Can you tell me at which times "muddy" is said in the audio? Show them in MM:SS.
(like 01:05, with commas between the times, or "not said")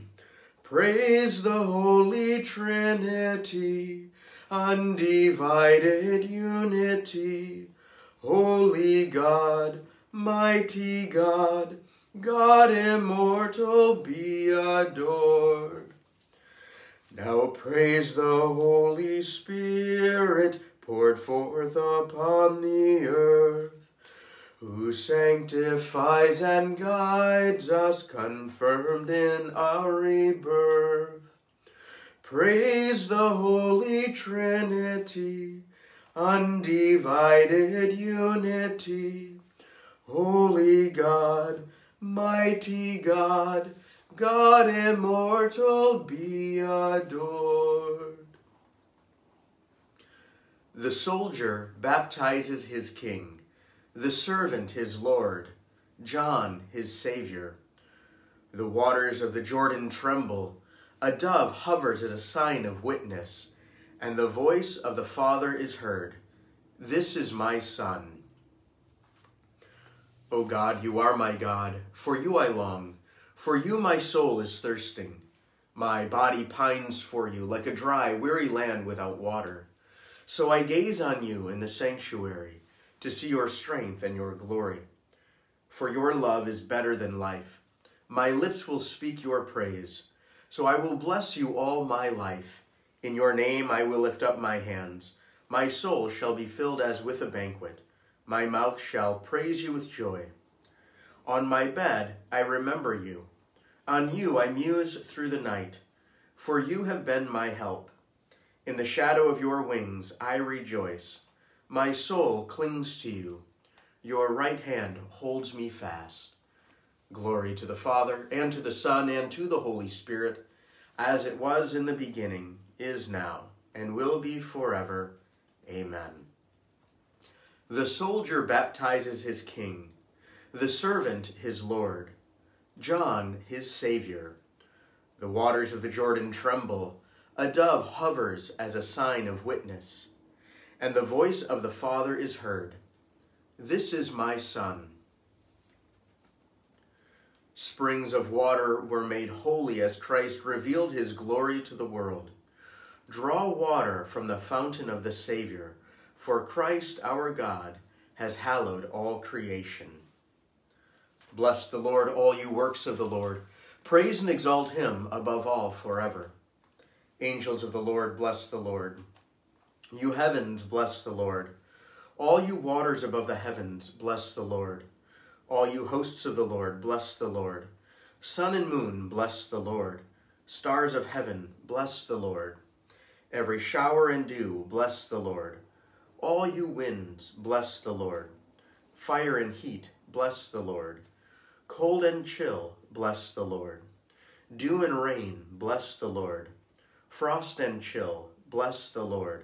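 not said.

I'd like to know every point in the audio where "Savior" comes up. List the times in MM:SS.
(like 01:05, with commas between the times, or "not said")
00:56, 02:13, 02:35.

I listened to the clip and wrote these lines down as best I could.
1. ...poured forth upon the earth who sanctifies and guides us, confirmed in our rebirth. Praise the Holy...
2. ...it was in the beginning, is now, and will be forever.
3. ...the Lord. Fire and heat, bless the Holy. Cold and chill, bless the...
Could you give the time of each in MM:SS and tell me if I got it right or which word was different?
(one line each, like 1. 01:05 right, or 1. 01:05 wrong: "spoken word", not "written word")
1. 00:20 right
2. 02:01 right
3. 03:07 wrong: "Lord", not "Holy".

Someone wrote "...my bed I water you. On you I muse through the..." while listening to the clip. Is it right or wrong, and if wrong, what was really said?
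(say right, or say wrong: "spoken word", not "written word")
wrong: "remember", not "water".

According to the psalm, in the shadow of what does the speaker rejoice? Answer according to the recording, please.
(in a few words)
your wings.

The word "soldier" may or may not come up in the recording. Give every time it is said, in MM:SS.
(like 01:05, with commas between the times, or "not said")
00:50, 02:07.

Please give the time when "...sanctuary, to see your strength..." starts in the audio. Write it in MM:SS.
01:21.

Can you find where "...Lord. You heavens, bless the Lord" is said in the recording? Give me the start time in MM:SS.
02:48.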